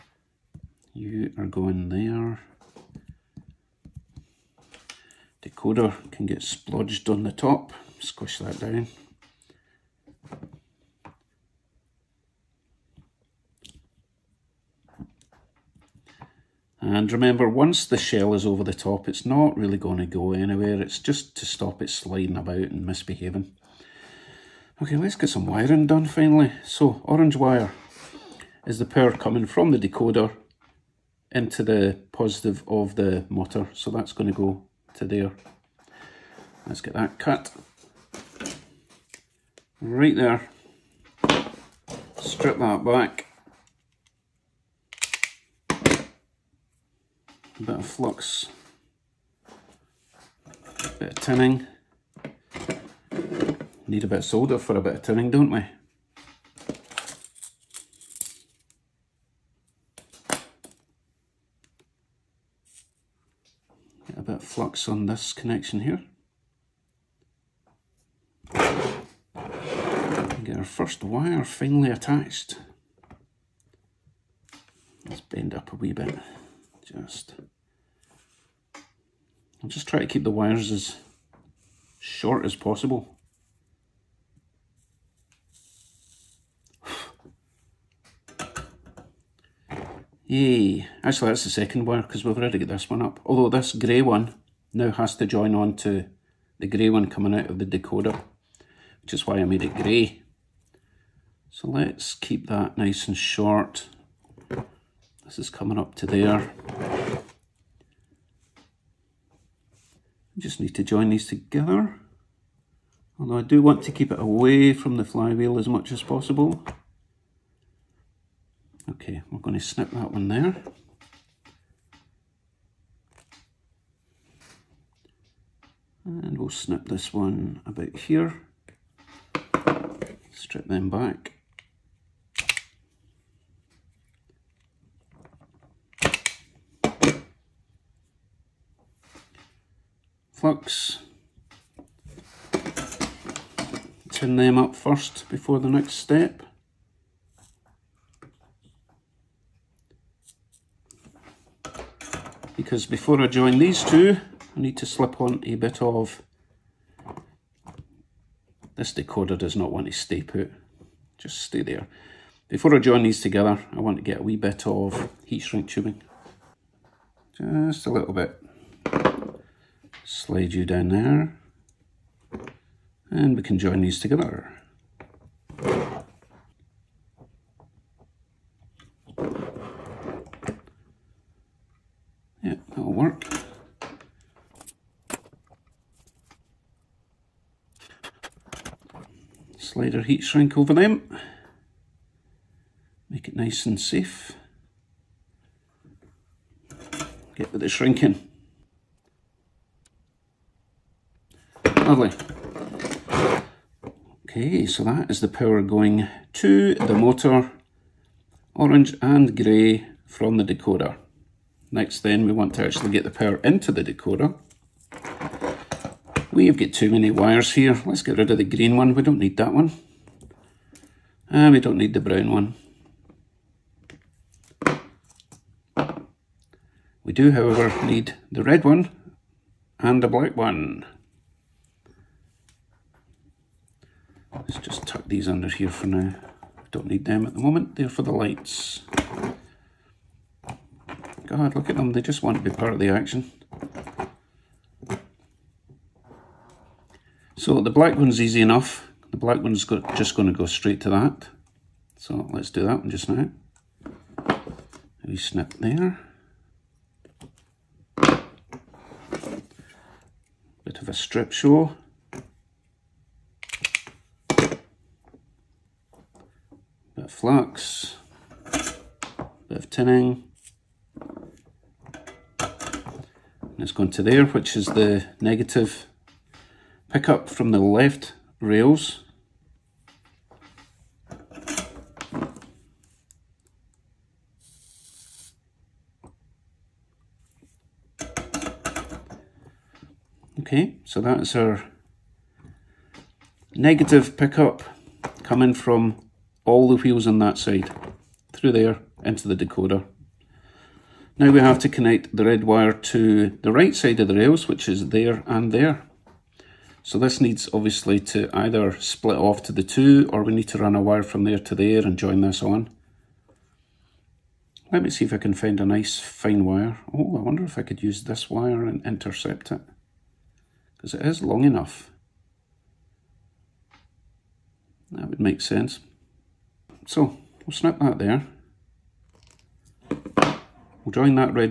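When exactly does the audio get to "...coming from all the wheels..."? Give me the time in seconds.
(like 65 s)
295 s.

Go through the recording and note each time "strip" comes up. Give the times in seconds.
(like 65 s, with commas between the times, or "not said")
42 s, 130 s, 260 s.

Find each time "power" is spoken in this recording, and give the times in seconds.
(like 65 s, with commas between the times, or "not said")
28 s, 205 s, 213 s.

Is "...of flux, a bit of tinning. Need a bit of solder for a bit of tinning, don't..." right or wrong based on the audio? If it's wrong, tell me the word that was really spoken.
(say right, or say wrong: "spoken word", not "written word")
right.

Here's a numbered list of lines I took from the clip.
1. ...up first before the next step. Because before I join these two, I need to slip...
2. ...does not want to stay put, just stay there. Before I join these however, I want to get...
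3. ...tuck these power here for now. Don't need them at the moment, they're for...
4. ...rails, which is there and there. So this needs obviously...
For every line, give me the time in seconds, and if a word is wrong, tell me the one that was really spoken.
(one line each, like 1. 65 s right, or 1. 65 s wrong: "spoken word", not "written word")
1. 144 s right
2. 159 s wrong: "together", not "however"
3. 234 s wrong: "under", not "power"
4. 304 s right.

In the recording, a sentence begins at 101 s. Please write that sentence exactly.
So let's keep that nice and short this is coming up to there.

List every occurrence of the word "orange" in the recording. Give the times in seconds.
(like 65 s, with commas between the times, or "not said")
27 s, 208 s.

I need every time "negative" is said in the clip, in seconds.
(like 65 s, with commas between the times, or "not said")
275 s, 293 s.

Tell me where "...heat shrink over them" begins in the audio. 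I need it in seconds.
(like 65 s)
190 s.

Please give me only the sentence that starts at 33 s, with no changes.
So that's going to go to there.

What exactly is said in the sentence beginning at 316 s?
Oh, I wonder if I could use this wire and intercept it.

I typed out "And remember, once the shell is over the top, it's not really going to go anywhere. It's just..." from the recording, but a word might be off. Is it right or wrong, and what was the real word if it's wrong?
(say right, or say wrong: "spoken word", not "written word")
right.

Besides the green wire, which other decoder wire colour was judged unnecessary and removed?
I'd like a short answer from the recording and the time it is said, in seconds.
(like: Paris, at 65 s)
Brown, at 222 s.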